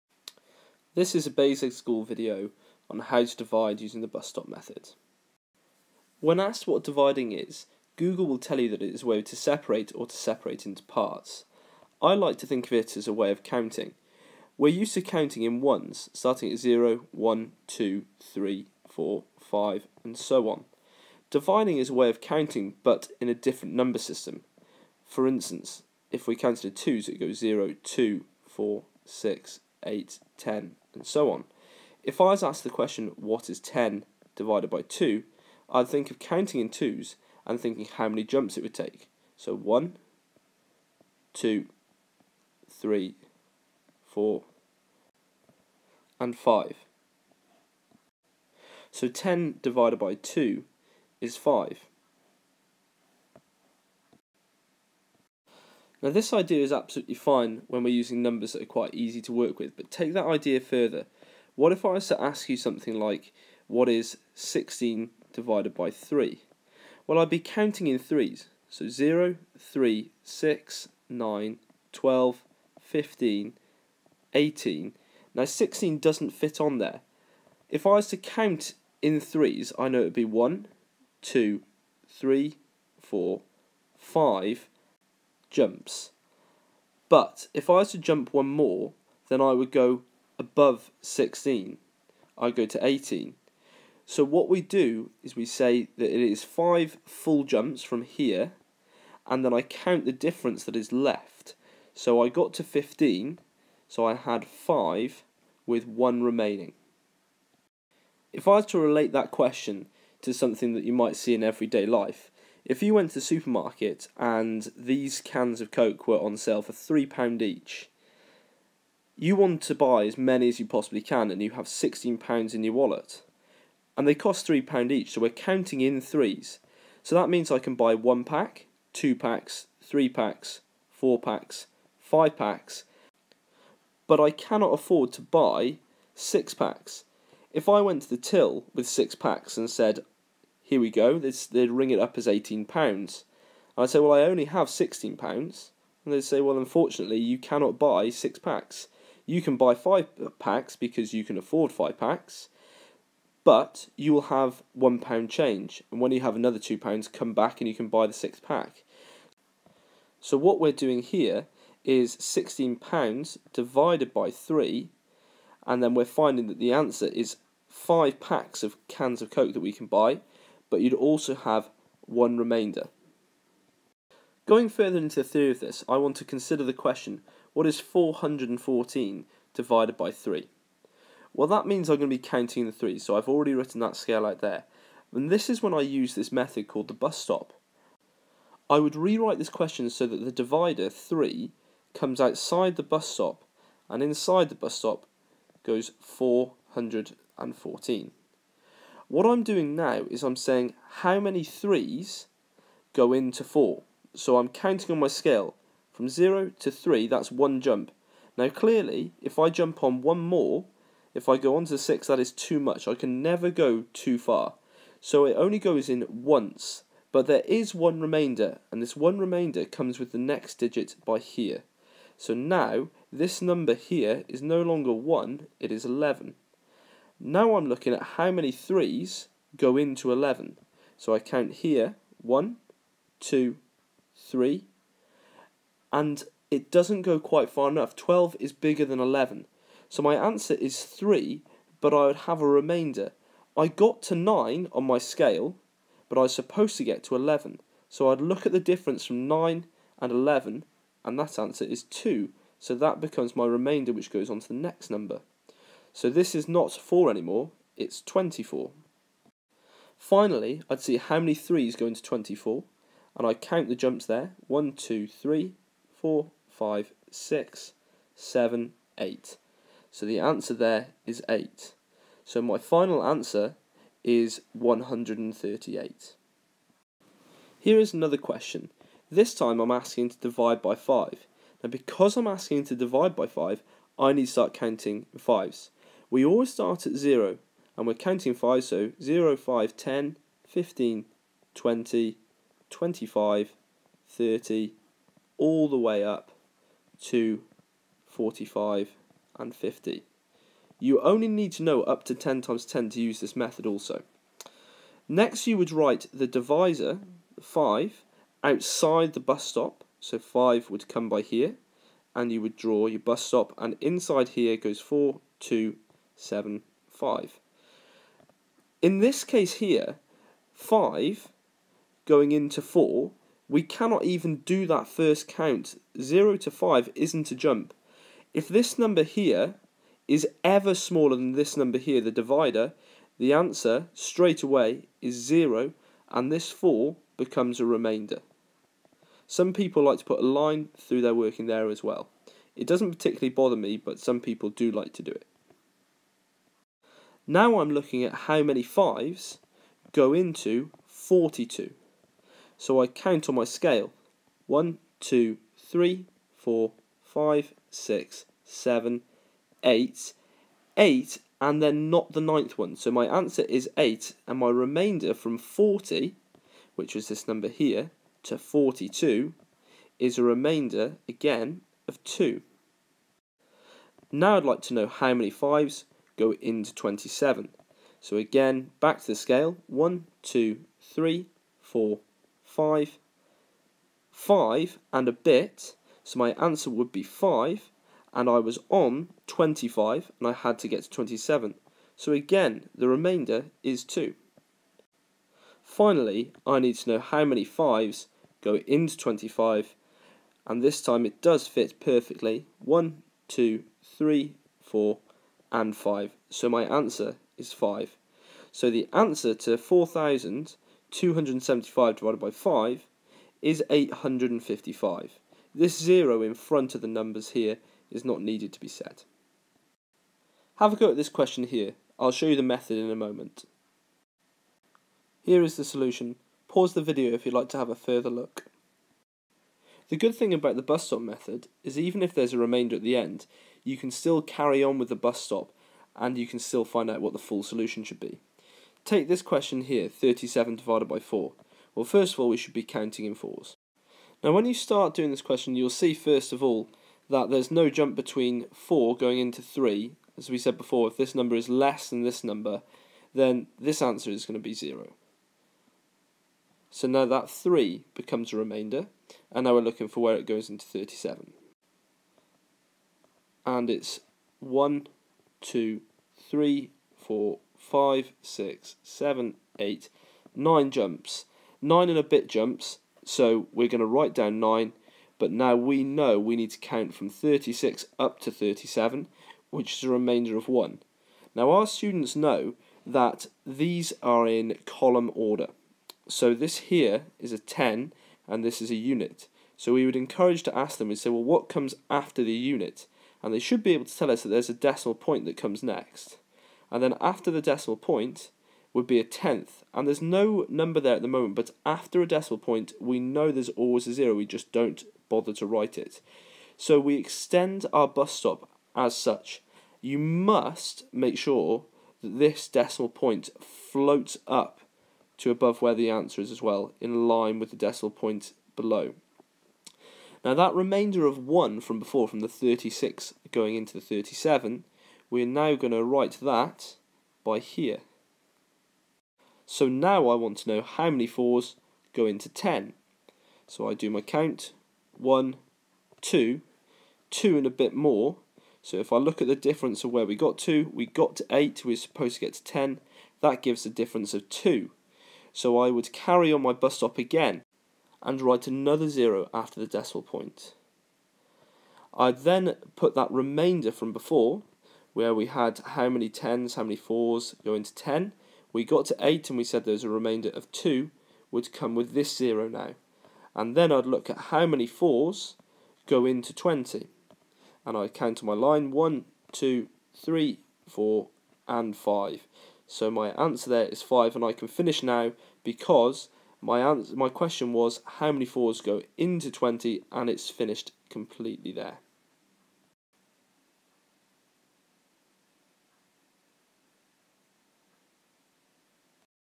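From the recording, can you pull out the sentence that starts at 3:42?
So now, this number here is no longer 1, it is 11.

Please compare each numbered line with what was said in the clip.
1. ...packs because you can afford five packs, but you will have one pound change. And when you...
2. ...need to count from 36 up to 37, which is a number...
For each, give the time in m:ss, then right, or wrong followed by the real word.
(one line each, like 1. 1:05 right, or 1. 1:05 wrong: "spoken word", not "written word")
1. 2:30 right
2. 7:56 wrong: "remainder", not "number".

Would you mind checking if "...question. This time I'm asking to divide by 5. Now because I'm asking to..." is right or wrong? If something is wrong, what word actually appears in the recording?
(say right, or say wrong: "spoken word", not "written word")
right.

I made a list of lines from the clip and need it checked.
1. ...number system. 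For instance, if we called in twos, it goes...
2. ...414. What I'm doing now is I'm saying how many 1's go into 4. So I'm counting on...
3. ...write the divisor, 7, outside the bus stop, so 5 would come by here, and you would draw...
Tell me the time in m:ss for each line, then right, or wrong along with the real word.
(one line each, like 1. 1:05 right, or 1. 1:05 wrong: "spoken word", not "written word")
1. 0:23 wrong: "counted", not "called"
2. 3:15 wrong: "3", not "1"
3. 5:05 wrong: "5", not "7".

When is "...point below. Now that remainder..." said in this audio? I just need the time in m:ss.
8:37.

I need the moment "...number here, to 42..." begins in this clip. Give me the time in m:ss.
6:07.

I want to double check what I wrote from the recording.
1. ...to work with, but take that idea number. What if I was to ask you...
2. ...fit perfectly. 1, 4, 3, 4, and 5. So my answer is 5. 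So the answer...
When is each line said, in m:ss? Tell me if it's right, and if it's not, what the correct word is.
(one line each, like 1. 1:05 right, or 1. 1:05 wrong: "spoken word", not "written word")
1. 0:59 wrong: "further", not "number"
2. 6:41 wrong: "2", not "4".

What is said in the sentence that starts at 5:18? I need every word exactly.
In this case here, five going into four, we cannot even do that first count.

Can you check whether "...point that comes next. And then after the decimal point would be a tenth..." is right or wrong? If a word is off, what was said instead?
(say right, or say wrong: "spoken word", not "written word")
right.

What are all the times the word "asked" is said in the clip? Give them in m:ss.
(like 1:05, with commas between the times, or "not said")
0:06, 0:32.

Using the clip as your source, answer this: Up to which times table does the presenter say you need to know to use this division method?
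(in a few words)
10 times 10.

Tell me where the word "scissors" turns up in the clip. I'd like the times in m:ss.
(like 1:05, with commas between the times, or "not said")
not said.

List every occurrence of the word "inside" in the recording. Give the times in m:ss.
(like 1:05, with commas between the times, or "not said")
3:14, 5:13.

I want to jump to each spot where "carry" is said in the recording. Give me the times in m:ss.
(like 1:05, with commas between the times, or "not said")
7:14, 9:05.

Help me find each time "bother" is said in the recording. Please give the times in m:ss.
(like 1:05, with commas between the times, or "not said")
5:43, 8:25.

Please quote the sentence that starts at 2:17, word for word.
If I went to the till with six packs and said, here we go, this, they'd ring it up as £18.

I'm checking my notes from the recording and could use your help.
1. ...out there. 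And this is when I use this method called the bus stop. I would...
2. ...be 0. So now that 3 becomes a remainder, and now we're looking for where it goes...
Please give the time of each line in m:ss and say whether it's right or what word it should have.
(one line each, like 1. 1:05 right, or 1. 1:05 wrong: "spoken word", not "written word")
1. 3:04 right
2. 7:34 right.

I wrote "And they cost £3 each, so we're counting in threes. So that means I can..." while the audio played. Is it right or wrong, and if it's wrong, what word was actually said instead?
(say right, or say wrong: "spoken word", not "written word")
right.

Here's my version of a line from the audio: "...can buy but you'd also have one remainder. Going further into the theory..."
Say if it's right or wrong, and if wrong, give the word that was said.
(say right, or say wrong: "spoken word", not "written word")
right.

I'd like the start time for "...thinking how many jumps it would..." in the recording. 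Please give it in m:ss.
0:37.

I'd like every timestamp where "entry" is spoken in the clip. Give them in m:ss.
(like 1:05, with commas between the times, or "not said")
not said.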